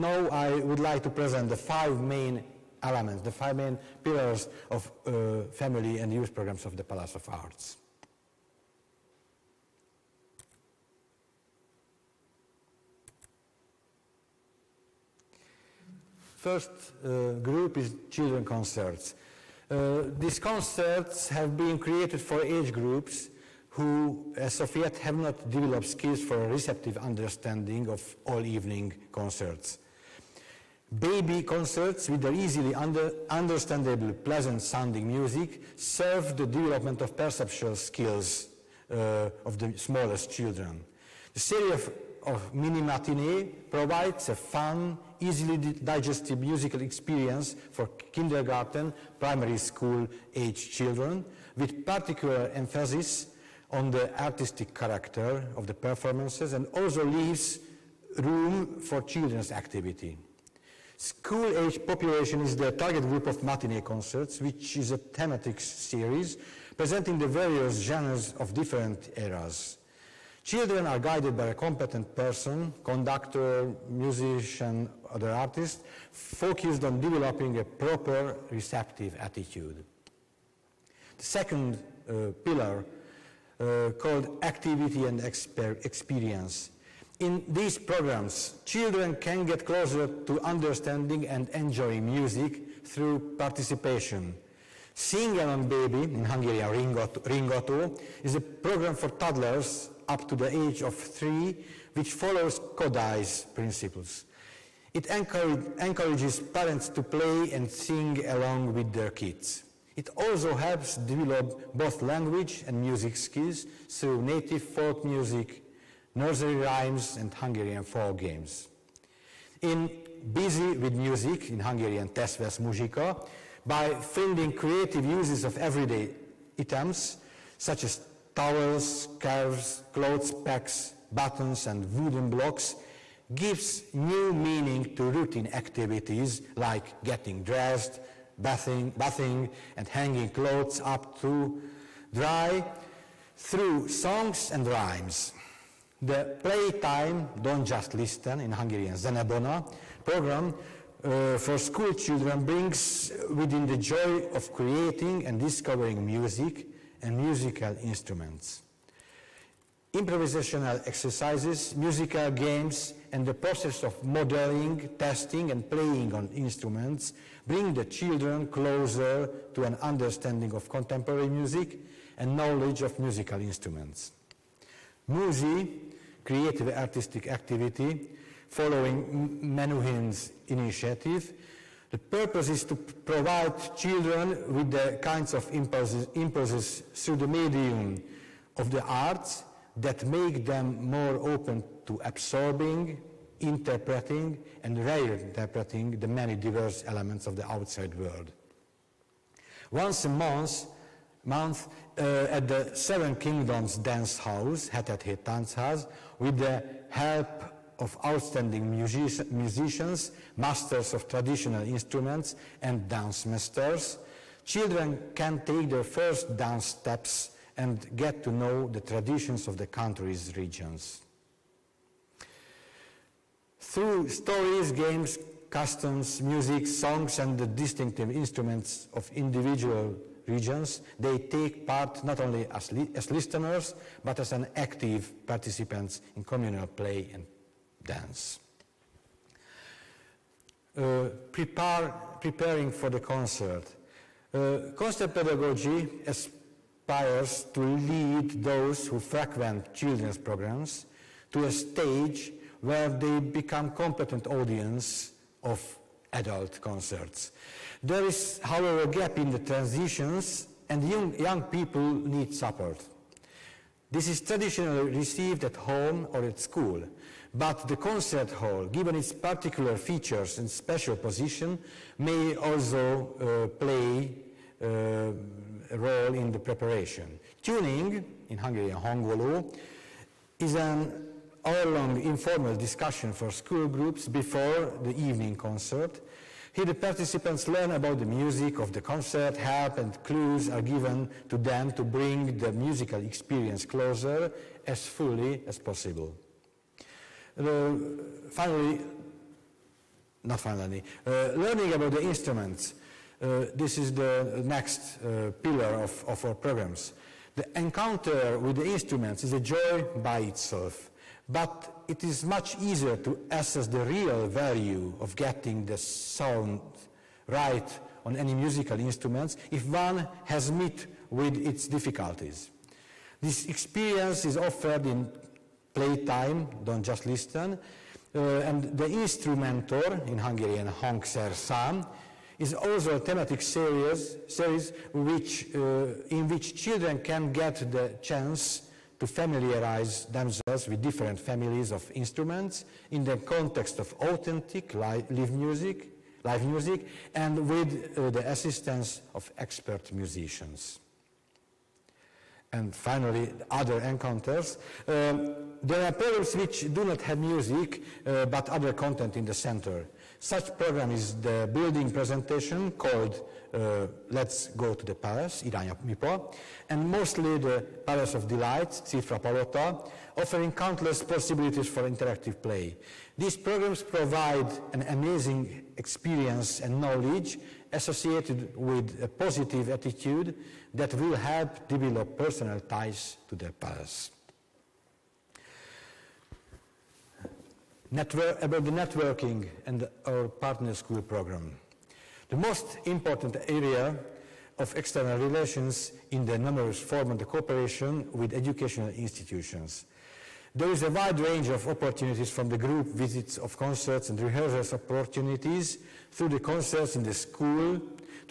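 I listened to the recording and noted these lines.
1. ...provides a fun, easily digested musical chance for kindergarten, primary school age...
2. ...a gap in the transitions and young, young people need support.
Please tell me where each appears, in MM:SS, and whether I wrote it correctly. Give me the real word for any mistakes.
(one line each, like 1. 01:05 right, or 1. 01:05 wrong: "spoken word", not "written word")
1. 00:43 wrong: "experience", not "chance"
2. 04:18 right.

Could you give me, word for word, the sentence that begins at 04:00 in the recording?
Uh, prepare, preparing for the concert.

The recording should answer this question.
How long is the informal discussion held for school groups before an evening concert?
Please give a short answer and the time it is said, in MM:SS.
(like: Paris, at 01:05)
1 hour, at 04:41.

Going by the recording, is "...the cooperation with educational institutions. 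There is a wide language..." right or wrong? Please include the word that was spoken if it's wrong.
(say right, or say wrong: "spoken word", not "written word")
wrong: "range", not "language".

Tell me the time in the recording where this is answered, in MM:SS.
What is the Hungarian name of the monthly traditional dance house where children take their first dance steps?
03:24.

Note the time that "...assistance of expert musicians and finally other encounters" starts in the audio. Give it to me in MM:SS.
05:48.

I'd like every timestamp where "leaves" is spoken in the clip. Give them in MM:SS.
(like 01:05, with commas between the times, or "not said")
00:57.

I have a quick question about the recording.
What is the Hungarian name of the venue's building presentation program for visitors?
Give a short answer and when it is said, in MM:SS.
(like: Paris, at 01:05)
Irány a Müpa, at 06:05.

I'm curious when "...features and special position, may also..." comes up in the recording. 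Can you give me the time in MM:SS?
04:29.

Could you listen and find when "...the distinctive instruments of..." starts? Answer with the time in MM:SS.
03:47.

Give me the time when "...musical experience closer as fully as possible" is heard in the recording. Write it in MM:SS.
04:52.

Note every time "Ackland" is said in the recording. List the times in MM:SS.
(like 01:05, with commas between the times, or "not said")
not said.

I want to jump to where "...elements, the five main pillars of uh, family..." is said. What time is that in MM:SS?
00:02.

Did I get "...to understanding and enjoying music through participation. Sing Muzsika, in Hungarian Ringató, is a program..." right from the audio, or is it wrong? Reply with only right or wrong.
wrong.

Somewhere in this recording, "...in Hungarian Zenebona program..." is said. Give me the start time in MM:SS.
02:28.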